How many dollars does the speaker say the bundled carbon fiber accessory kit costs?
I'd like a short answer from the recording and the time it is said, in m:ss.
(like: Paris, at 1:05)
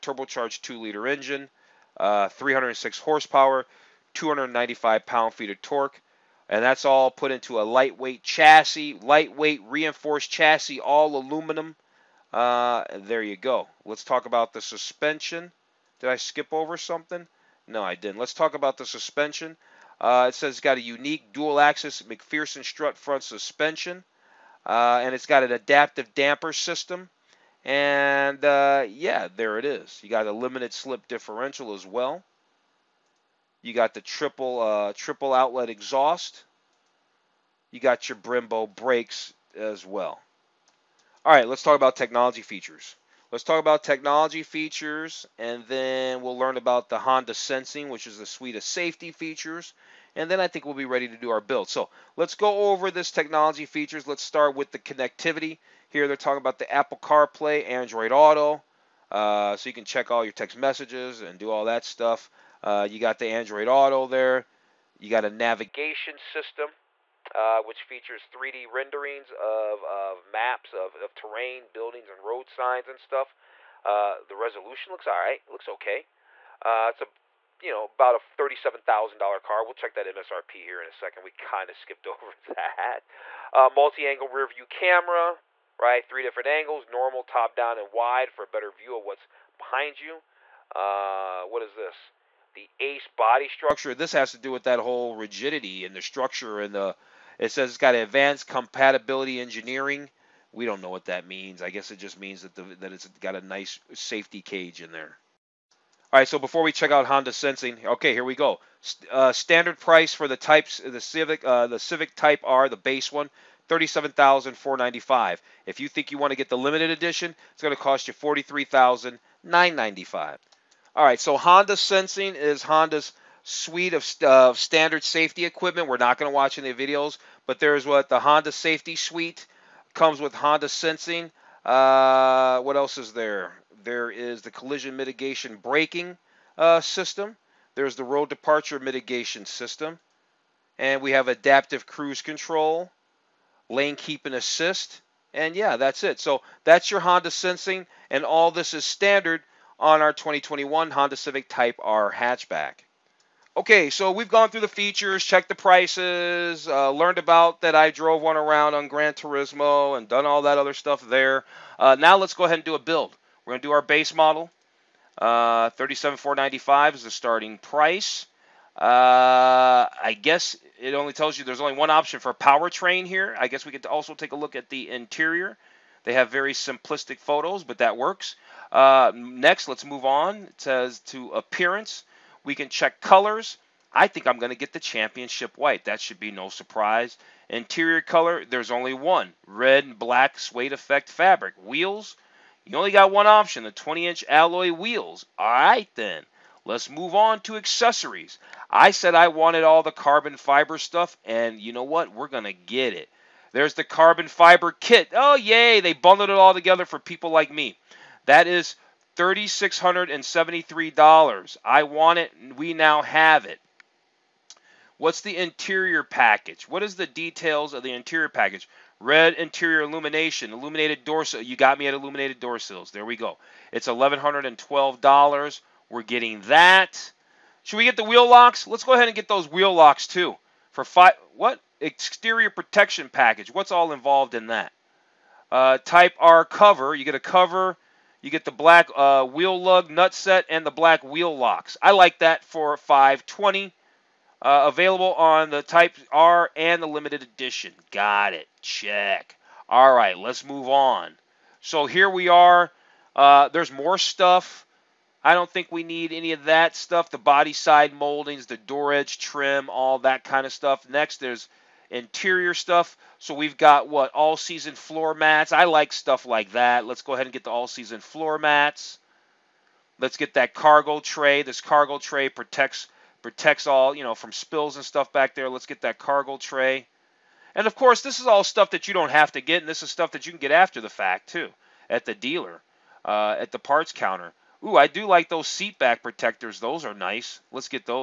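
$3,673, at 3:29.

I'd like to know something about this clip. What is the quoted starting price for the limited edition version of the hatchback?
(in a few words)
$43,995.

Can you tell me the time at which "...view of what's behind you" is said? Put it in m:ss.
1:28.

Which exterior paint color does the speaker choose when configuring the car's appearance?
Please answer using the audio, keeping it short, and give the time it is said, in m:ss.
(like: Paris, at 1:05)
Championship White, at 3:04.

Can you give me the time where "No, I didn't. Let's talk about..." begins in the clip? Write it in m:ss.
0:17.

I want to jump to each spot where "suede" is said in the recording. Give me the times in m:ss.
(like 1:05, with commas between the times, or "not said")
3:10.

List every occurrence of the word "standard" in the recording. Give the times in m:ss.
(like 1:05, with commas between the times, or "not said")
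1:49, 2:04, 2:28.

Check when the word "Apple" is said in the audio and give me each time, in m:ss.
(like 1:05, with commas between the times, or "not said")
0:56.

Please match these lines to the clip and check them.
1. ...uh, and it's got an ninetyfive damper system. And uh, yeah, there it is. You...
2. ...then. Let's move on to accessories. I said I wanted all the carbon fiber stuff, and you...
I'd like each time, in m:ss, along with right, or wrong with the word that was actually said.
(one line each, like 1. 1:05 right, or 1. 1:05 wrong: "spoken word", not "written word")
1. 0:24 wrong: "adaptive", not "ninetyfive"
2. 3:15 right.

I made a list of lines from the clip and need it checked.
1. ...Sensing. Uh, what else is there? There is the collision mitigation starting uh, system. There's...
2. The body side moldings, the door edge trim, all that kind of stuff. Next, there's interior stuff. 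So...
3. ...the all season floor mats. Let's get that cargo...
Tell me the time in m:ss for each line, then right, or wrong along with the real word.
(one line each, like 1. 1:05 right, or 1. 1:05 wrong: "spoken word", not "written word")
1. 2:10 wrong: "braking", not "starting"
2. 4:17 right
3. 4:27 right.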